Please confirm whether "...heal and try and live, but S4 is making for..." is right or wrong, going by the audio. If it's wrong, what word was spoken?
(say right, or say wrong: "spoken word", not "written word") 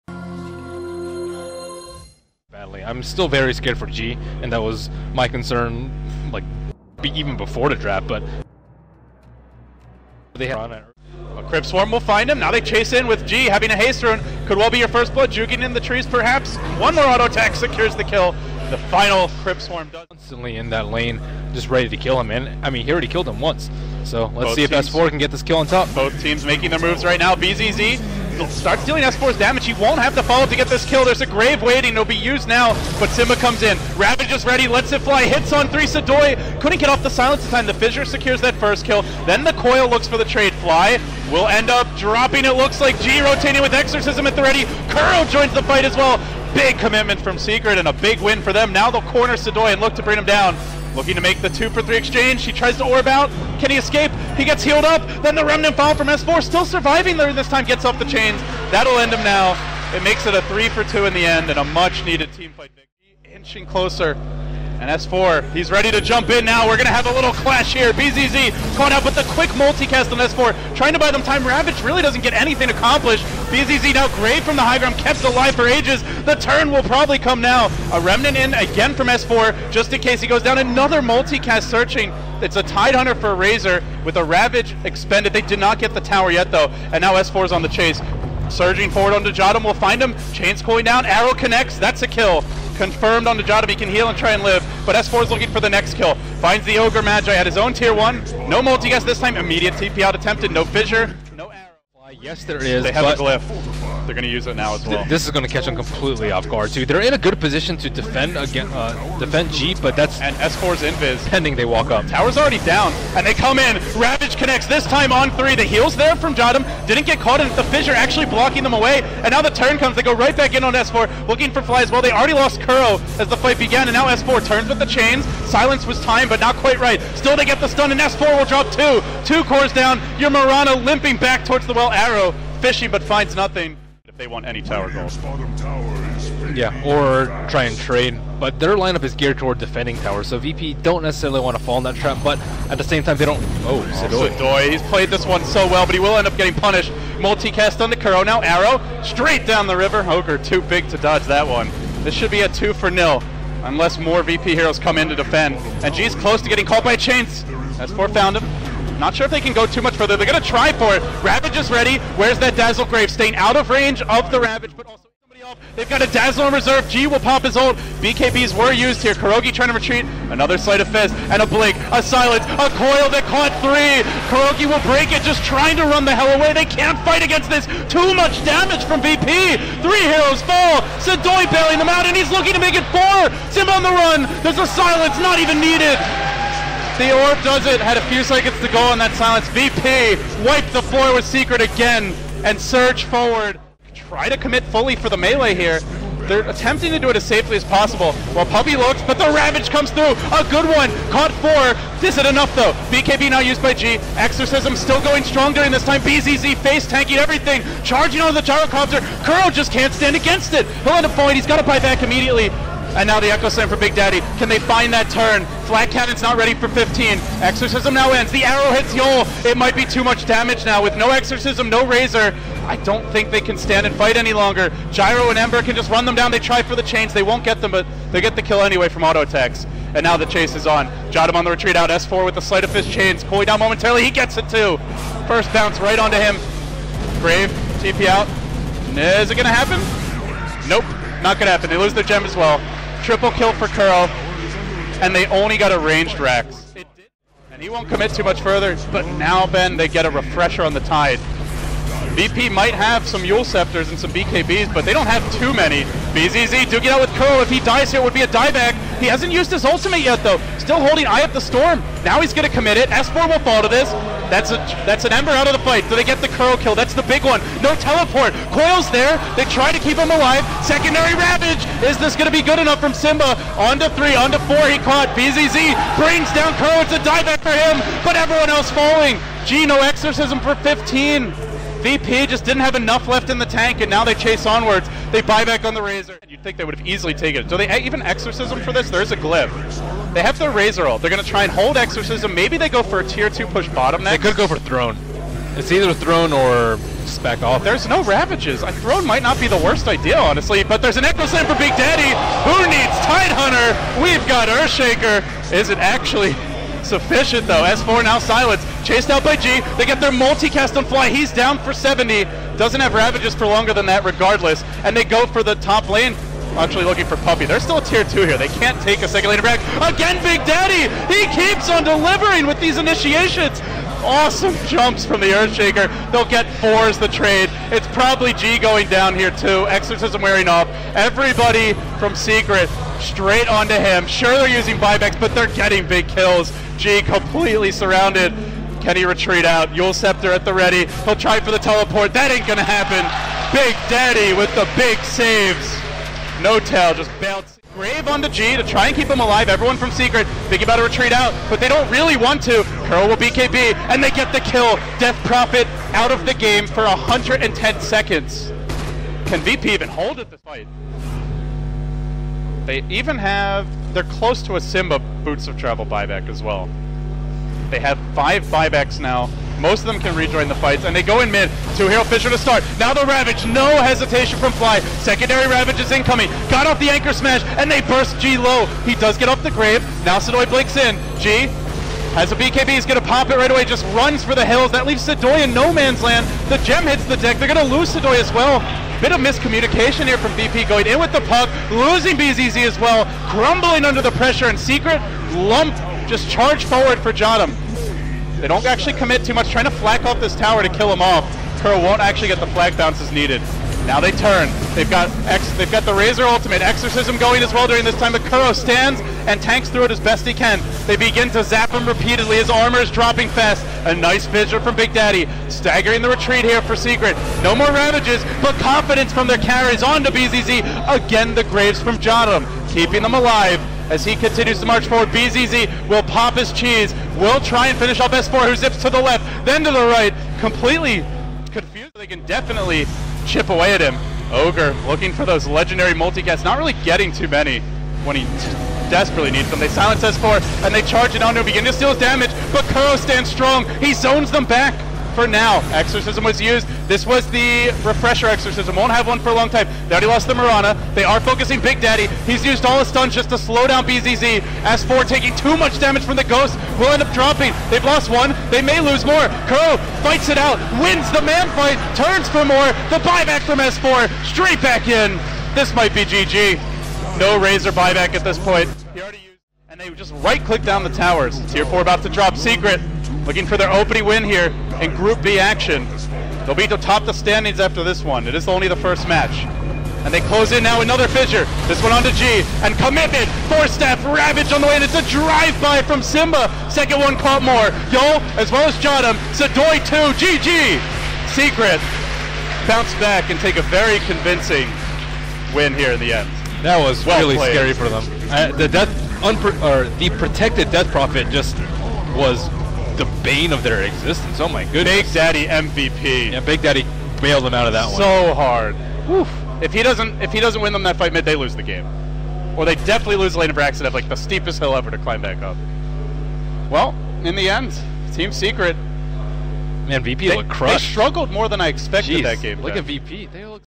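wrong: "looking", not "making".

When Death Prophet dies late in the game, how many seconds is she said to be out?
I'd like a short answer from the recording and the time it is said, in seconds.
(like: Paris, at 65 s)
110, at 356 s.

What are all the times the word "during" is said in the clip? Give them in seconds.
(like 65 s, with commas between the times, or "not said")
205 s, 407 s.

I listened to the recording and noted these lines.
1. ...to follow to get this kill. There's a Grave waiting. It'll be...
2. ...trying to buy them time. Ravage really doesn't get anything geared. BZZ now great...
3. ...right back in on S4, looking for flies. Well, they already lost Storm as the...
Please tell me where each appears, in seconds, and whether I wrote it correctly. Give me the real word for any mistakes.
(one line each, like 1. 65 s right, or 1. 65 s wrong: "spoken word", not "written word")
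1. 30 s right
2. 70 s wrong: "accomplished", not "geared"
3. 120 s wrong: "Kuro", not "Storm".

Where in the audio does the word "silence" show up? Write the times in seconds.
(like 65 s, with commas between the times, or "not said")
37 s, 125 s, 172 s, 184 s, 189 s, 308 s, 439 s.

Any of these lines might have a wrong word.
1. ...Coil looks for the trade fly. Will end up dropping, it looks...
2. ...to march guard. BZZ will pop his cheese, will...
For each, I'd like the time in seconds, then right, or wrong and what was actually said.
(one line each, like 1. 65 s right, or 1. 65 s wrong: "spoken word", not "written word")
1. 39 s right
2. 424 s wrong: "forward", not "guard".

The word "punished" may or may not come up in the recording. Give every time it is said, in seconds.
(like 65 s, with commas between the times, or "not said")
146 s.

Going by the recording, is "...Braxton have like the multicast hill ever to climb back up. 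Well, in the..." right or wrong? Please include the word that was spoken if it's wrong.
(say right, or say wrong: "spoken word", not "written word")
wrong: "steepest", not "multicast".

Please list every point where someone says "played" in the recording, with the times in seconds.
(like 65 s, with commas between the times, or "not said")
144 s, 497 s.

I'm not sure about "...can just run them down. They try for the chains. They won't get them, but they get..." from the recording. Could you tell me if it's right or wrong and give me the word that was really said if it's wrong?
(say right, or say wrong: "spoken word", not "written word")
right.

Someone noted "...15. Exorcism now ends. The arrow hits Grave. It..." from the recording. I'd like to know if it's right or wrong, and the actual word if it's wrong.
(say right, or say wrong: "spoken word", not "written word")
wrong: "Yol", not "Grave".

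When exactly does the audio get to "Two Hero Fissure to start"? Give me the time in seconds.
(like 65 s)
371 s.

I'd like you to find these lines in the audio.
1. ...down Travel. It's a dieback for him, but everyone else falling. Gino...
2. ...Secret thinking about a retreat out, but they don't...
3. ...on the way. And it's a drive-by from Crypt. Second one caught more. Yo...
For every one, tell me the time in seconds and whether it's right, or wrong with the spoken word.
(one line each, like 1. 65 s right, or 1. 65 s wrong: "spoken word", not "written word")
1. 276 s wrong: "Kuro", not "Travel"
2. 349 s right
3. 484 s wrong: "Simba", not "Crypt".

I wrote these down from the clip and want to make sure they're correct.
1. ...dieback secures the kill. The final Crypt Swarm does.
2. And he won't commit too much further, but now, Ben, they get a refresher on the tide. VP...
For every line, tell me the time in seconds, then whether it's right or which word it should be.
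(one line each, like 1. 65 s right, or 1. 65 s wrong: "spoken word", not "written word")
1. 17 s wrong: "attack", not "dieback"
2. 247 s right.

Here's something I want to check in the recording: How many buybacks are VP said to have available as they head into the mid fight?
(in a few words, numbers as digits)
5.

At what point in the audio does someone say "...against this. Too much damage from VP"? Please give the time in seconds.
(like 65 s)
177 s.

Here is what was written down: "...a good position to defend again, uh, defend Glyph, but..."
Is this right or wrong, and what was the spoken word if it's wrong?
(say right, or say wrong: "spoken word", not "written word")
wrong: "Jeep", not "Glyph".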